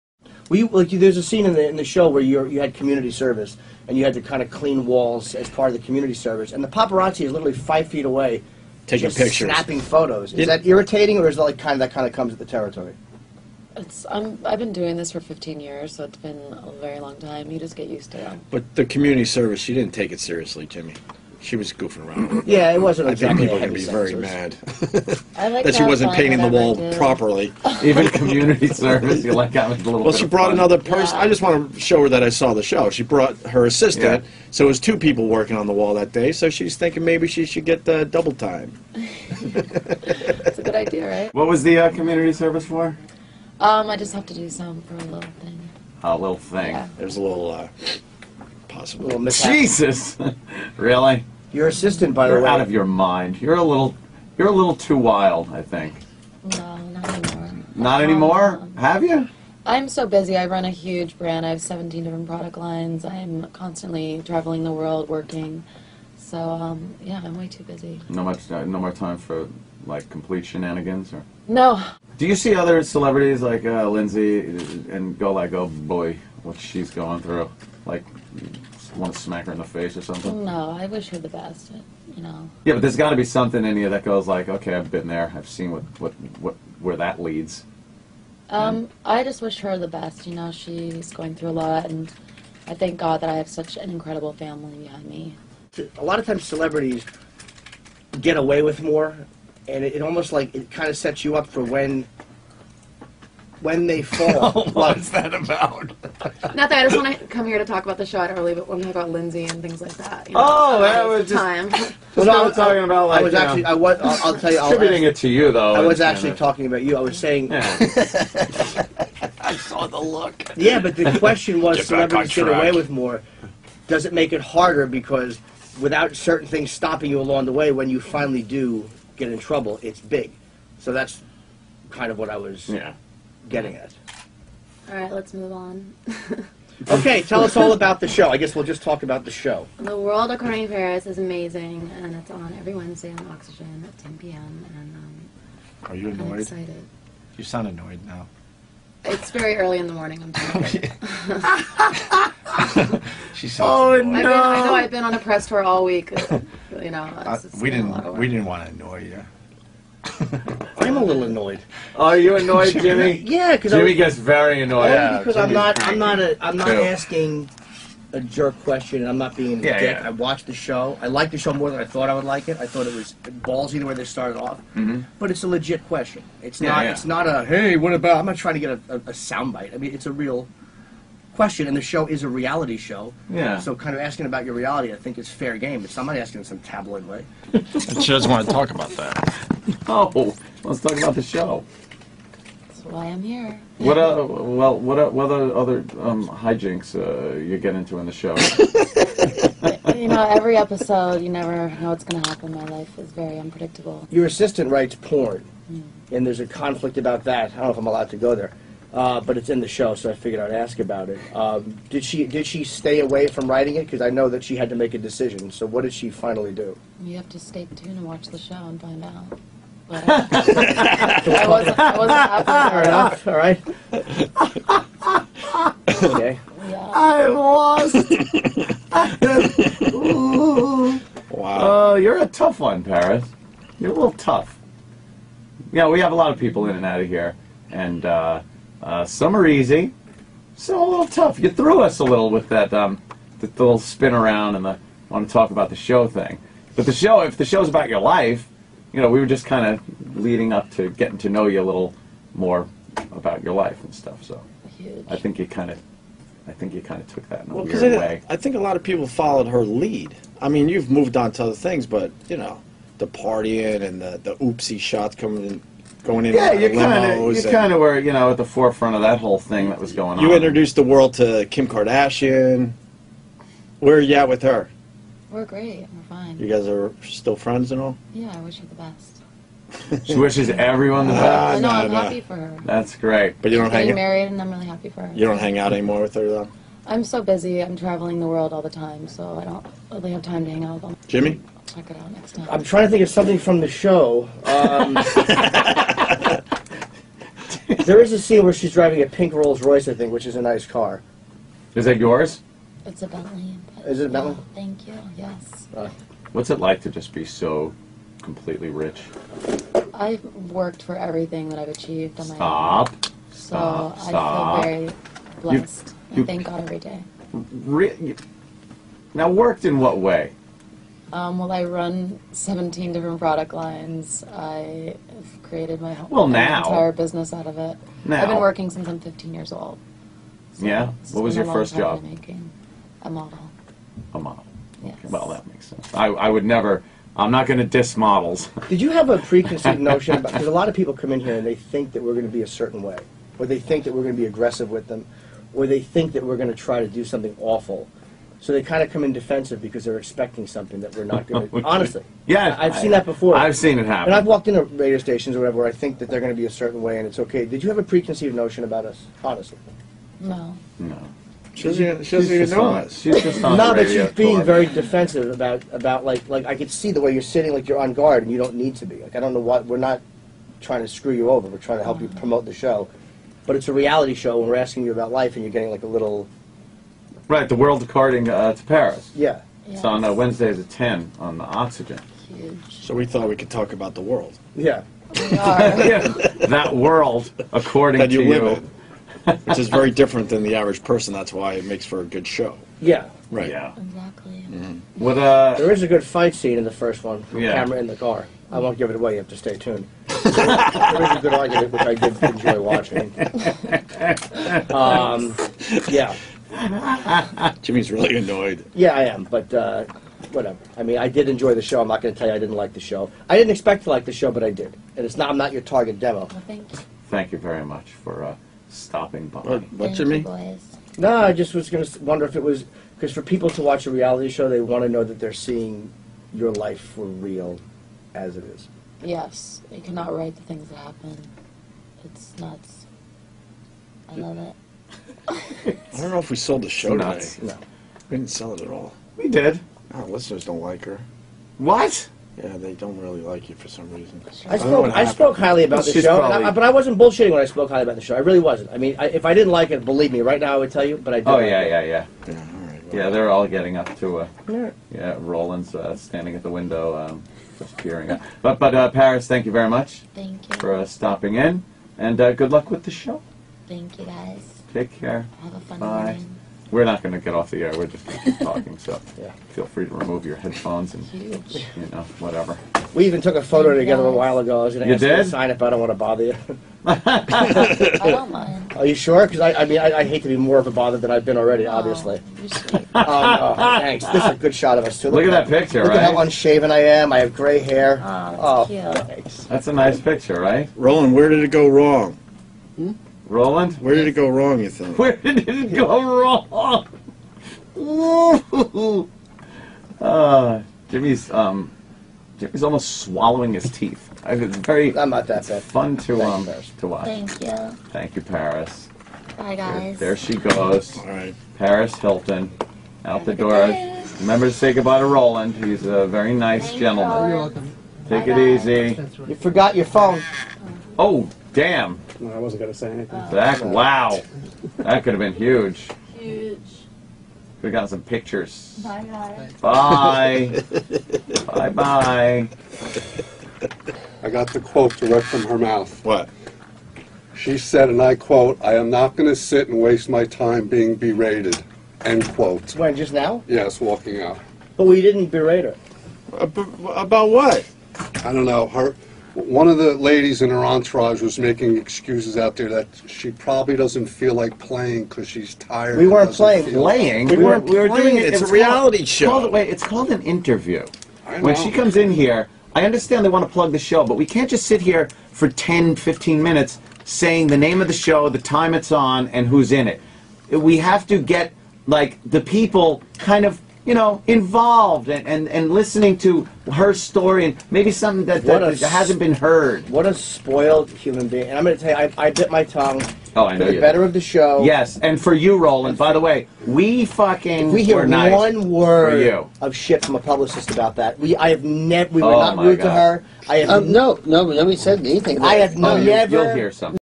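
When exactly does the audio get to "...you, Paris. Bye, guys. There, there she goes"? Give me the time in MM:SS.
08:28.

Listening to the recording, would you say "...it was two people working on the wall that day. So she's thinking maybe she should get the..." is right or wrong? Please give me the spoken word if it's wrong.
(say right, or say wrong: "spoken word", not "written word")
right.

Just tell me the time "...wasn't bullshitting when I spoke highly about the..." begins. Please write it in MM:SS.
07:26.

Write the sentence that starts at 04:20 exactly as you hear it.
I mean, you've moved on to other things, but you know, the partying and the the oopsie shots coming going in.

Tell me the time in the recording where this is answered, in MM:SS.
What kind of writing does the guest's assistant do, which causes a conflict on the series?
03:24.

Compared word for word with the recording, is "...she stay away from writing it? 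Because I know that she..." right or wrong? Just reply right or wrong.
right.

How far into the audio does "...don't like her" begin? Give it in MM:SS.
07:20.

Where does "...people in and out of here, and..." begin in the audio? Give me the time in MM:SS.
03:56.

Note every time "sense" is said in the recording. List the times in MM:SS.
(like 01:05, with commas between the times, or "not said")
05:35.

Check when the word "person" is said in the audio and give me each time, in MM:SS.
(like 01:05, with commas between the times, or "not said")
00:30, 06:30.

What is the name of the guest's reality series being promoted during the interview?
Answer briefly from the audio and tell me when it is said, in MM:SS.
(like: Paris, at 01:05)
The World According to Paris, at 02:19.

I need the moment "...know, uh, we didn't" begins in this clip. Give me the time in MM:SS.
02:36.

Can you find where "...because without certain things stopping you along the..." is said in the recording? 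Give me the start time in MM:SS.
02:04.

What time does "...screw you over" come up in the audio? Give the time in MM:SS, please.
06:10.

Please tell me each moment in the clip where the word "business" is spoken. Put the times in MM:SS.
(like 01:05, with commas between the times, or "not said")
05:26.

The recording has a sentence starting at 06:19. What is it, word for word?
it's on uh, wednesdays at 10 on the oxygen Huge.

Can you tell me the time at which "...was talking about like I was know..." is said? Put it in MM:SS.
01:52.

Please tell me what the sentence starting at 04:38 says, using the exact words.
Yeah, I wish her the best.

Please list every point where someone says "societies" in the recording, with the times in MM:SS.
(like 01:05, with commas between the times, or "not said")
not said.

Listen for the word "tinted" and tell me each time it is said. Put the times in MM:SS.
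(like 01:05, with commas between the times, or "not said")
not said.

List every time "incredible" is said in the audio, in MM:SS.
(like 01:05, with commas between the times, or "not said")
01:33.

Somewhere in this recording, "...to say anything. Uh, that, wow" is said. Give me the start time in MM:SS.
08:42.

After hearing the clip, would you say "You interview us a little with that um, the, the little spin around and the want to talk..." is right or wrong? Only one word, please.
wrong.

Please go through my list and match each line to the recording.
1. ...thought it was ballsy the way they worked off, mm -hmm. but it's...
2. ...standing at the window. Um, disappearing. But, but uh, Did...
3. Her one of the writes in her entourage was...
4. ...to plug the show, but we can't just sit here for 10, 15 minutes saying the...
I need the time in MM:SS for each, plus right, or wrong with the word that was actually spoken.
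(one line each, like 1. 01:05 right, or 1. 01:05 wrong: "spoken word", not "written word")
1. 02:52 wrong: "started", not "worked"
2. 07:35 wrong: "Paris", not "Did"
3. 09:08 wrong: "ladies", not "writes"
4. 09:23 right.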